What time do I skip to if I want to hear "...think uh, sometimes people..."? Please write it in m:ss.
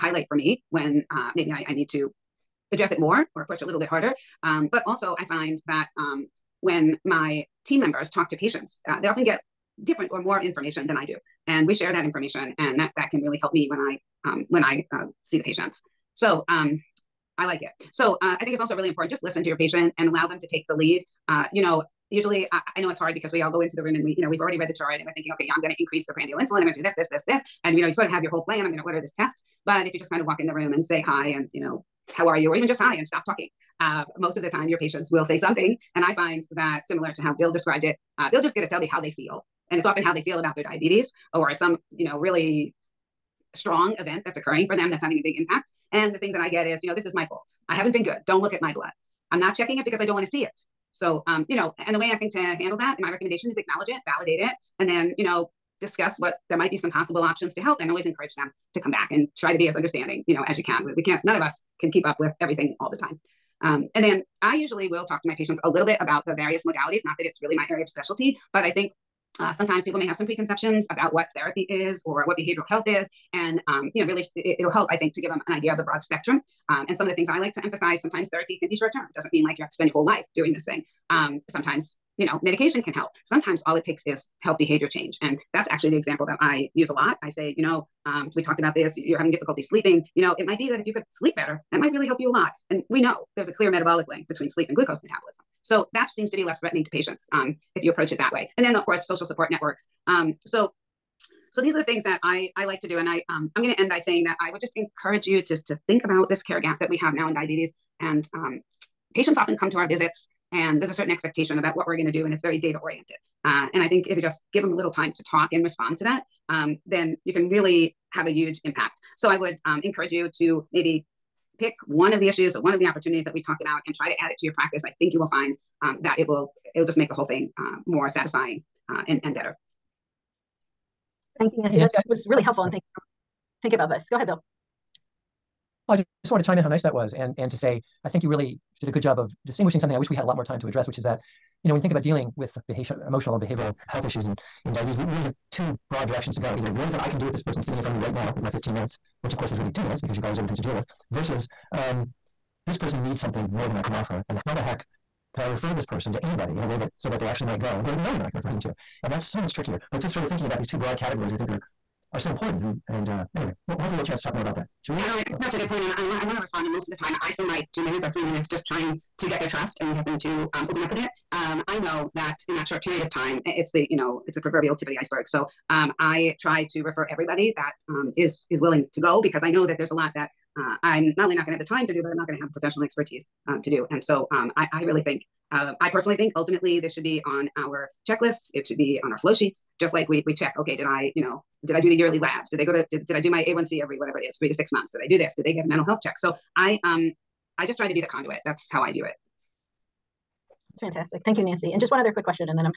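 1:08.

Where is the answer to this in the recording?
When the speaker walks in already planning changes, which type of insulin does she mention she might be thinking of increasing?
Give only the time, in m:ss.
0:26.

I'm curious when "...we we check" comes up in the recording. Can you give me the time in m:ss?
3:10.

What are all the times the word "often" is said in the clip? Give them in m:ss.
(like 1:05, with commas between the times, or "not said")
0:09, 0:39, 1:49.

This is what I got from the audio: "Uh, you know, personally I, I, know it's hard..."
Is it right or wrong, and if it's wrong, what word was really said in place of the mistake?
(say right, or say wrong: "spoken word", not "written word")
wrong: "usually", not "personally".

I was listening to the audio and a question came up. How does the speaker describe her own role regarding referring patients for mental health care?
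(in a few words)
the conduit.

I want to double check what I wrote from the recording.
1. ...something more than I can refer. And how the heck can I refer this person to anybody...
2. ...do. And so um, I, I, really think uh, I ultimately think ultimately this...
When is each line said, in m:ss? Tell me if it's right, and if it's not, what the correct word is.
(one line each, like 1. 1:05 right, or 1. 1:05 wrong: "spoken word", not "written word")
1. 2:33 wrong: "offer", not "refer"
2. 3:03 wrong: "personally", not "ultimately".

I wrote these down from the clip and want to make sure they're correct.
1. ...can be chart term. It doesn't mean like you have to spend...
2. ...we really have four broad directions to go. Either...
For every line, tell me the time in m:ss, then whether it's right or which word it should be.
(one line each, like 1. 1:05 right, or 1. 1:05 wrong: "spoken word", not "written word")
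1. 1:18 wrong: "short", not "chart"
2. 2:25 wrong: "two", not "four".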